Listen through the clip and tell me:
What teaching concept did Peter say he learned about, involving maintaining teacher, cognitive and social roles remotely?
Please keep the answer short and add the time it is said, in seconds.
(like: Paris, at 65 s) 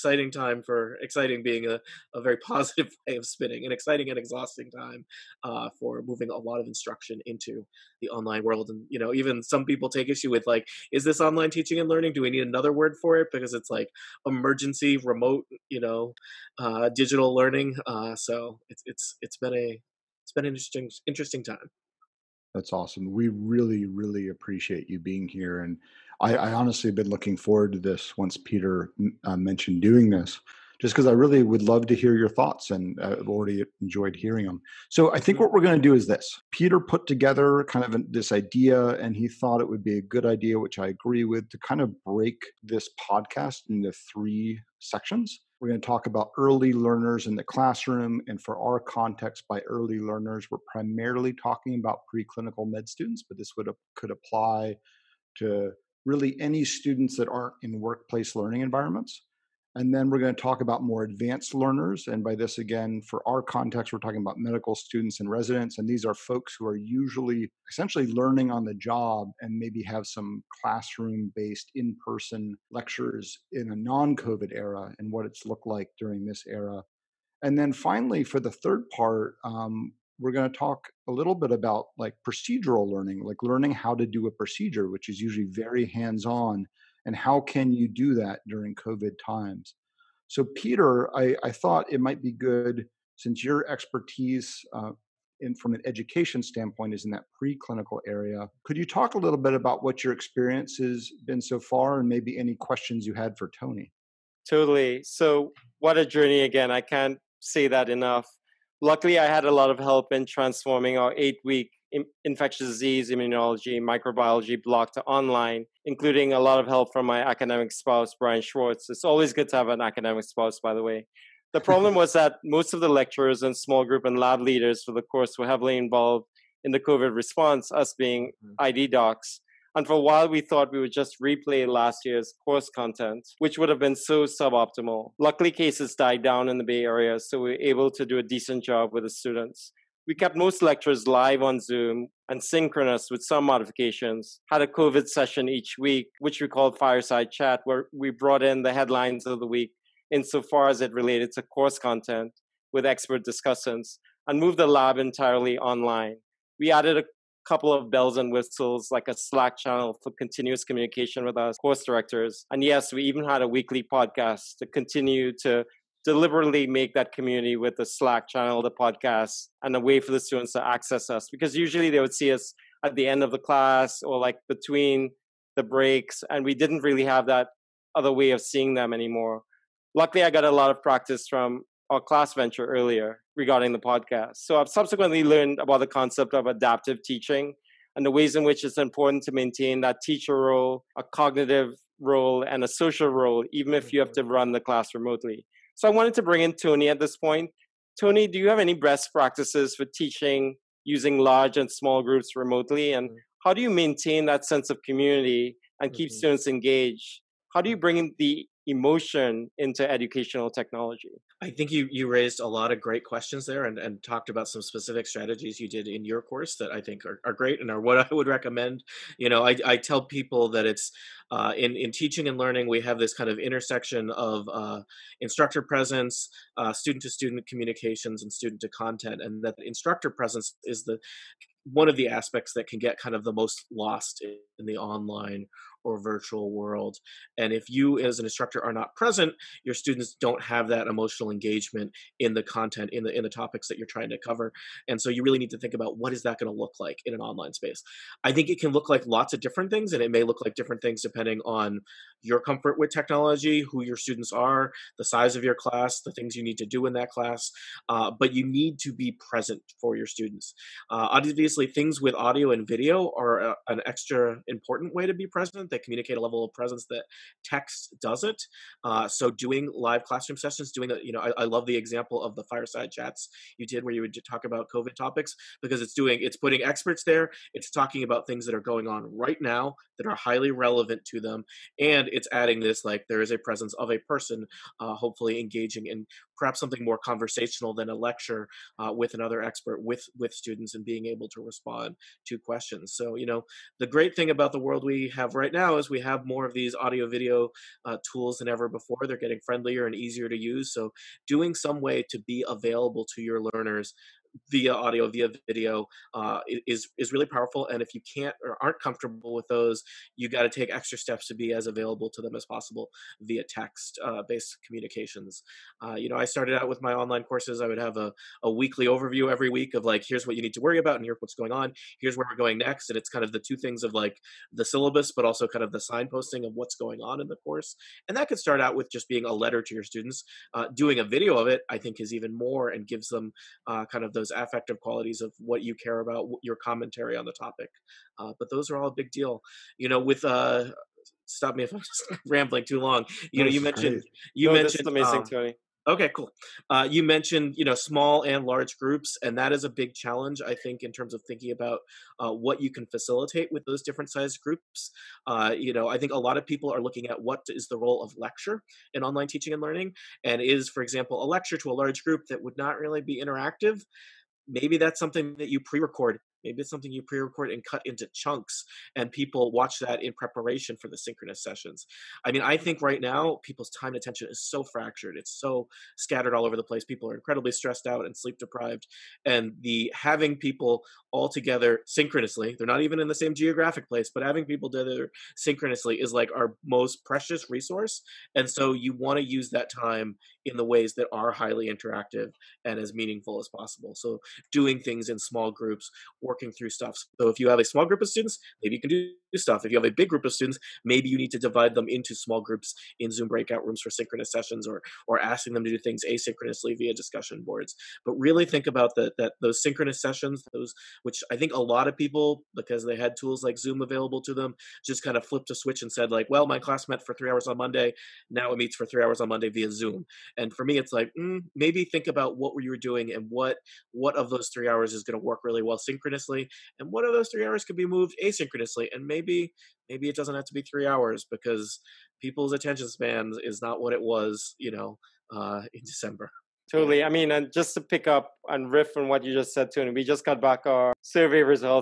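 adaptive teaching, at 186 s.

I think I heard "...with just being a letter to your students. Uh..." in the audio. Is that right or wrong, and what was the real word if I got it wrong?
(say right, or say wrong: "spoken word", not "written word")
right.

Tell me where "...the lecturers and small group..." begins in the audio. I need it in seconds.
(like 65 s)
122 s.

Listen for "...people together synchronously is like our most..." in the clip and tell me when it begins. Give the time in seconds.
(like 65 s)
384 s.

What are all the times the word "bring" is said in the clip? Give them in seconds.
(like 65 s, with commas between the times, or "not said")
196 s, 207 s.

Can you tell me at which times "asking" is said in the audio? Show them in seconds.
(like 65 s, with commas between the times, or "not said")
405 s.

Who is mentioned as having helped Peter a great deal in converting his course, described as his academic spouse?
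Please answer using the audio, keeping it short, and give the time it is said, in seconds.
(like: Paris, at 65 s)
Brian Schwartz, at 118 s.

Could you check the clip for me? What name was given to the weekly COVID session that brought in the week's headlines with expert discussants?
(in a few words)
Fireside Chat.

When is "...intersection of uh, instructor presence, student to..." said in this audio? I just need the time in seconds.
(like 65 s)
223 s.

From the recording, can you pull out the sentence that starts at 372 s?
I mean, I think right now people's time and attention is so fractured, it's so scattered all over the place.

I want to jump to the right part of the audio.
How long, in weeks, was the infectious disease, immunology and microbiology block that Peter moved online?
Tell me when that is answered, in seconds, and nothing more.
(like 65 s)
111 s.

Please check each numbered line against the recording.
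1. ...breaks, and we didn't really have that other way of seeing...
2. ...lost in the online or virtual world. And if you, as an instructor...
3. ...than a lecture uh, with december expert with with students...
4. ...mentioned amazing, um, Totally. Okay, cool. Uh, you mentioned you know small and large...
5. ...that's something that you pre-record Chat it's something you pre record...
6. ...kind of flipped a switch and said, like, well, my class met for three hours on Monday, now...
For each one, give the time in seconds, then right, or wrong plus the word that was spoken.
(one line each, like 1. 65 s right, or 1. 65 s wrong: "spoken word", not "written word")
1. 175 s right
2. 233 s right
3. 287 s wrong: "another", not "december"
4. 344 s wrong: "Tony", not "Totally"
5. 364 s wrong: "Maybe", not "Chat"
6. 415 s right.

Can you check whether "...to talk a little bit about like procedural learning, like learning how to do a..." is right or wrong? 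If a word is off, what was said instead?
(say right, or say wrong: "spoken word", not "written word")
right.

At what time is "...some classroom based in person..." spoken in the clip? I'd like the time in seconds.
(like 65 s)
70 s.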